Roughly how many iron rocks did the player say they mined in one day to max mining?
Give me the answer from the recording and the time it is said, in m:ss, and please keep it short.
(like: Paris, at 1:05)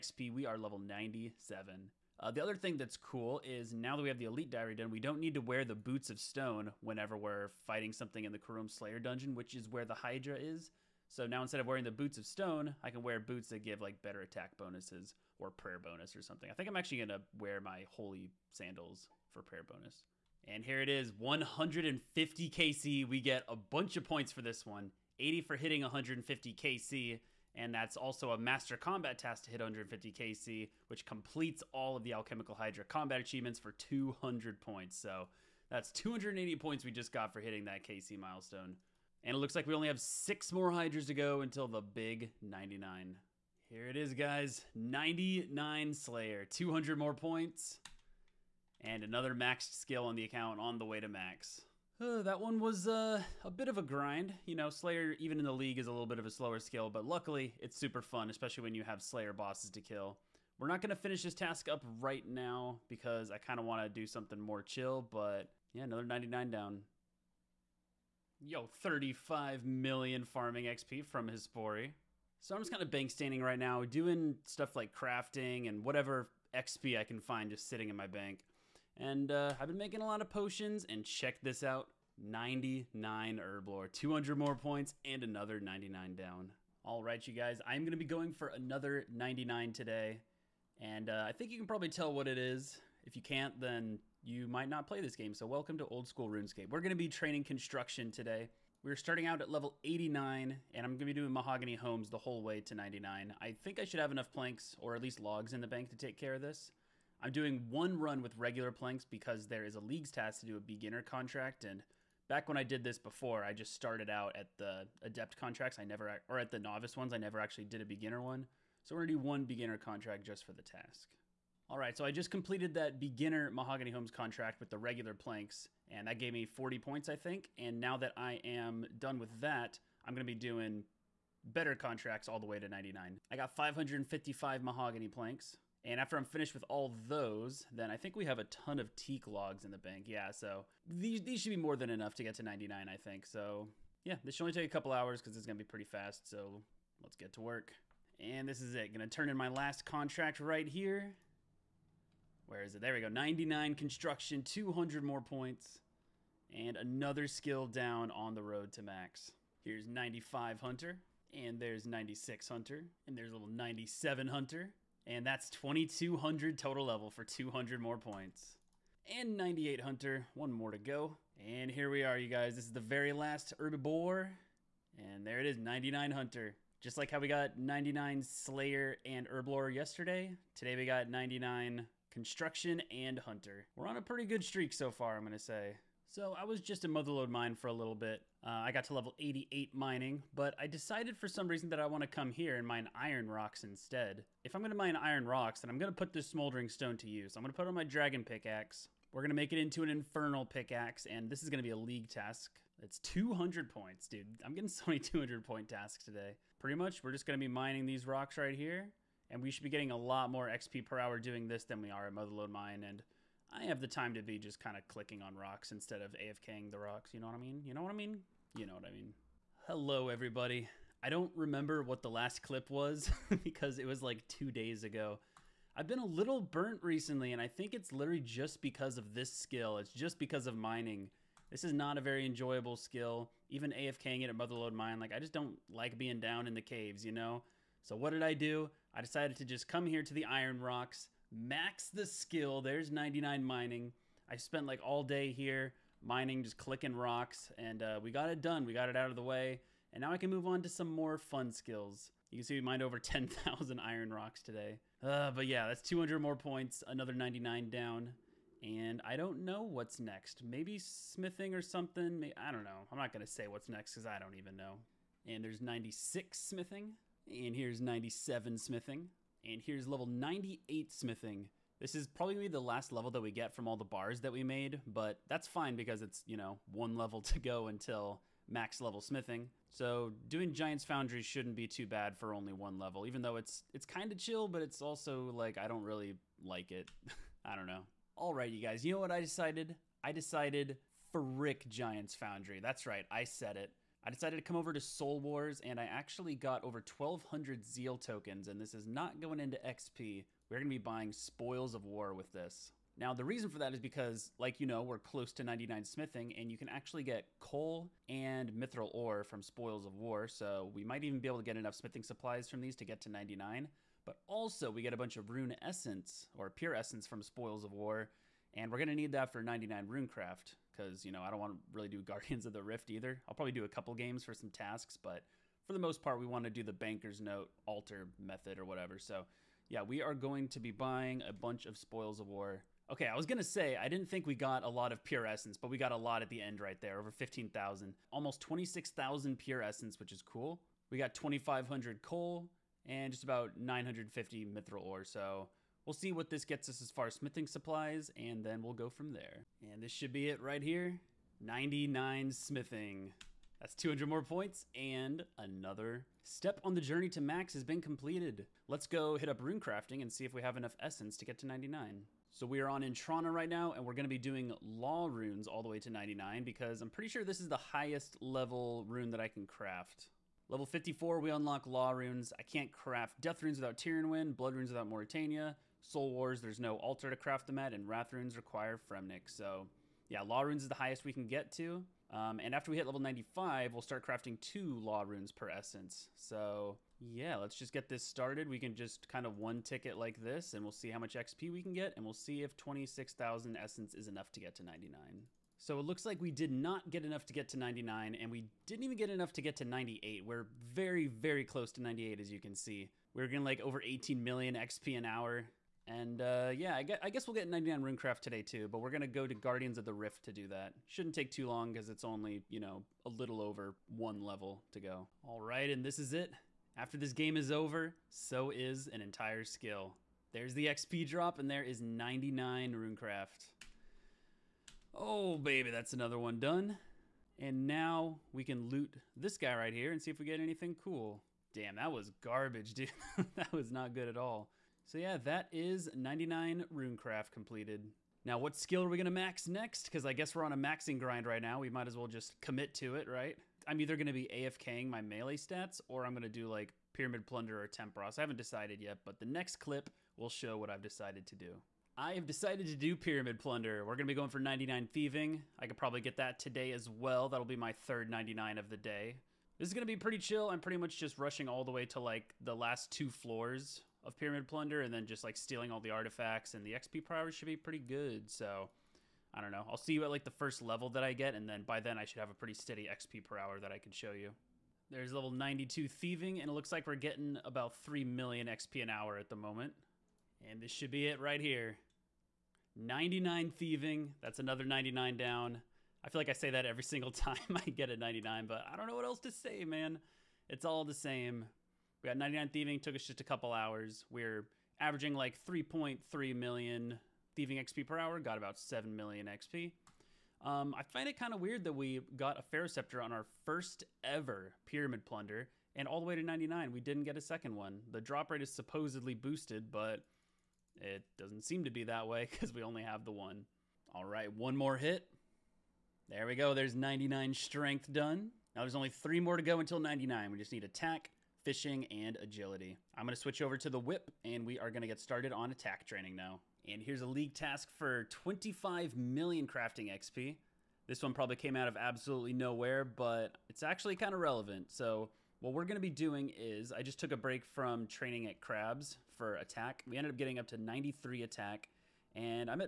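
10,000, at 4:12.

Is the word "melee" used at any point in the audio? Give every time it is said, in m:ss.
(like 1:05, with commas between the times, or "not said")
7:25.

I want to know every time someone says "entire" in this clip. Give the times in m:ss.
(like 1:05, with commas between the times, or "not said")
6:59.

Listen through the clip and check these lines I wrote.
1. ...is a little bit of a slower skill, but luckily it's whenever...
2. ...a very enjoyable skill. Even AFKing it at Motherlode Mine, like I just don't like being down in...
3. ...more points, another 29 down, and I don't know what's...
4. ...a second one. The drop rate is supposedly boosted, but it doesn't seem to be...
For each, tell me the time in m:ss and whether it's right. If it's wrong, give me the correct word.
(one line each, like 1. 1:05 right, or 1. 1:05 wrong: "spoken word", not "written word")
1. 0:55 wrong: "super", not "whenever"
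2. 3:51 right
3. 4:16 wrong: "99", not "29"
4. 8:27 right.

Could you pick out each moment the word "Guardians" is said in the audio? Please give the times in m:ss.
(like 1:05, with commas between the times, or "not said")
5:22, 6:49.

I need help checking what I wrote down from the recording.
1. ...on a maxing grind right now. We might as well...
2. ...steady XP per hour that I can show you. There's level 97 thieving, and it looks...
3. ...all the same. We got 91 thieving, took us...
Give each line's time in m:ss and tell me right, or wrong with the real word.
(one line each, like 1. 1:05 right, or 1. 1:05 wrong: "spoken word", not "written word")
1. 7:20 right
2. 7:52 wrong: "92", not "97"
3. 8:10 wrong: "99", not "91".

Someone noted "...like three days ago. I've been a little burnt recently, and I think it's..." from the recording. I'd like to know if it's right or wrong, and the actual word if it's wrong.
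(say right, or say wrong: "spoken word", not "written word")
wrong: "two", not "three".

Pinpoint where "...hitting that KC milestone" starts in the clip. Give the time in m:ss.
0:37.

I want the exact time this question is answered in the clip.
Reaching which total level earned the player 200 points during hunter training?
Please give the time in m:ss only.
2:45.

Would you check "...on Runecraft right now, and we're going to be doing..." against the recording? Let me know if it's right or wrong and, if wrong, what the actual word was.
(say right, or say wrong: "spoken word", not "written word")
wrong: "Entrana", not "Runecraft".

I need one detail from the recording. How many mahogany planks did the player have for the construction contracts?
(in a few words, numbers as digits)
555.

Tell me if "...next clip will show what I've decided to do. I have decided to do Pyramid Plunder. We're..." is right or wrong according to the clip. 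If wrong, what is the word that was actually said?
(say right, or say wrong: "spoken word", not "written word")
right.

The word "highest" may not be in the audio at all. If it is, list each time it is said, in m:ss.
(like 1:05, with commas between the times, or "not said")
6:07, 6:20.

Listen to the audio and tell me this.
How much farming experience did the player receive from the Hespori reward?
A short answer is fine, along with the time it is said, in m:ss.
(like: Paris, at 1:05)
35 million, at 1:08.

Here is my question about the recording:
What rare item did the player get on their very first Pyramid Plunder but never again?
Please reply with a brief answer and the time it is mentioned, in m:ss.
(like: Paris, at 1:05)
Scepter, at 8:22.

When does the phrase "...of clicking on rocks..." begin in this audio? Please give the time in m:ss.
3:34.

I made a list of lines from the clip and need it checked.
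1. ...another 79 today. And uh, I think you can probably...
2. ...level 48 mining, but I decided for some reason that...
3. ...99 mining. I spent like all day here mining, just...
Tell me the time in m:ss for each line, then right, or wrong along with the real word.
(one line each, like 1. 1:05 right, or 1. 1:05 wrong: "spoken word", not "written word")
1. 1:28 wrong: "99", not "79"
2. 3:08 wrong: "88", not "48"
3. 4:02 right.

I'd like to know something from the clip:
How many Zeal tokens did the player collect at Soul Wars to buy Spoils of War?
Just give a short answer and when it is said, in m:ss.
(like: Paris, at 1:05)
1200, at 4:56.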